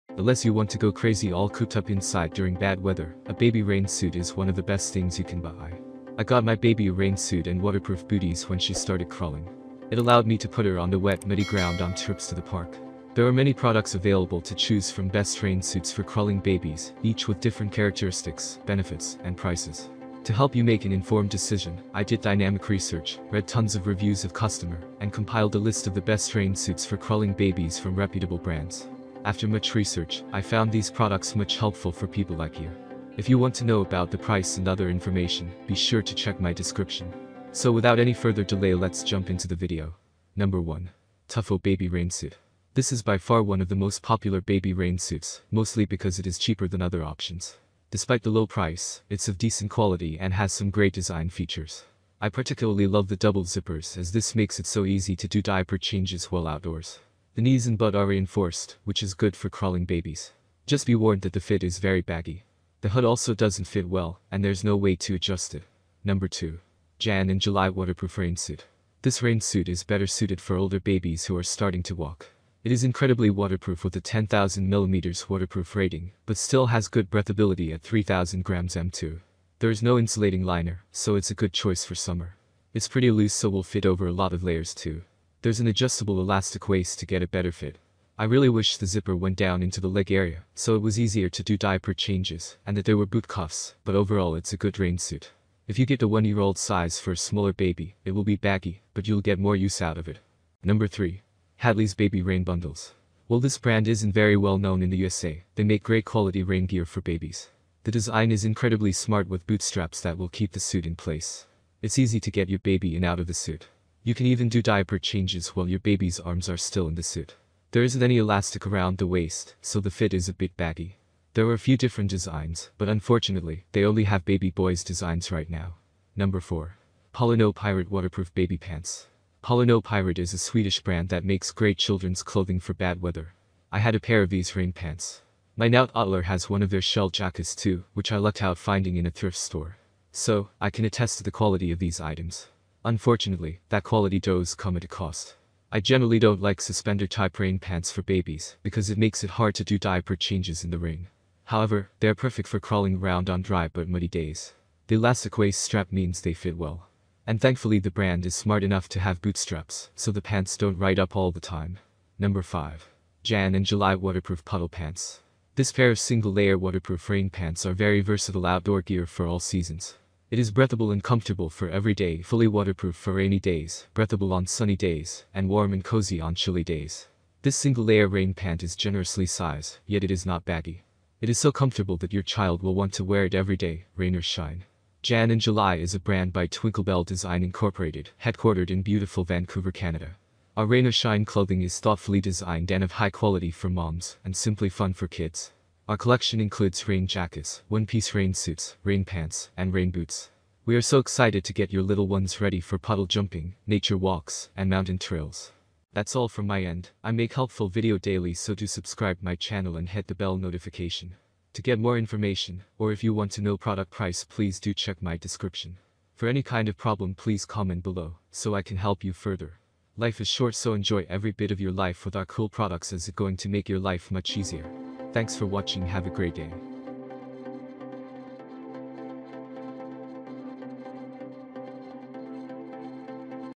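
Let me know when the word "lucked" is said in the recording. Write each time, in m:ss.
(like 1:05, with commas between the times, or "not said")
2:18.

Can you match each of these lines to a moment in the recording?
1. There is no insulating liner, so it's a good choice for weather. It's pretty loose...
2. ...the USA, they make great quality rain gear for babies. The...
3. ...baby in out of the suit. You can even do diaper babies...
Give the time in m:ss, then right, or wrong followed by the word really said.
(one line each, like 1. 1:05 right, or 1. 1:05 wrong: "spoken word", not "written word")
1. 1:19 wrong: "summer", not "weather"
2. 1:44 right
3. 1:52 wrong: "changes", not "babies".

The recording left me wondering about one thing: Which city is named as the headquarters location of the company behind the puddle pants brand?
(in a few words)
Vancouver.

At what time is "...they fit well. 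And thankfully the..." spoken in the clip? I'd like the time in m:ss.
2:36.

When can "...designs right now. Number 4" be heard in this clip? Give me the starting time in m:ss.
2:04.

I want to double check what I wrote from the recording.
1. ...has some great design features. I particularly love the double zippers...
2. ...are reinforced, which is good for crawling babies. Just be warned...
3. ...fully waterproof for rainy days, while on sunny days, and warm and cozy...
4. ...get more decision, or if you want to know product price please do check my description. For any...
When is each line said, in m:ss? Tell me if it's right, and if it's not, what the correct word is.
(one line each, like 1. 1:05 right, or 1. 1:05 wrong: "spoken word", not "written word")
1. 0:50 right
2. 0:57 right
3. 2:52 wrong: "breathable", not "while"
4. 3:31 wrong: "information", not "decision".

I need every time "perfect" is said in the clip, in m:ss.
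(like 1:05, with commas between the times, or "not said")
2:32.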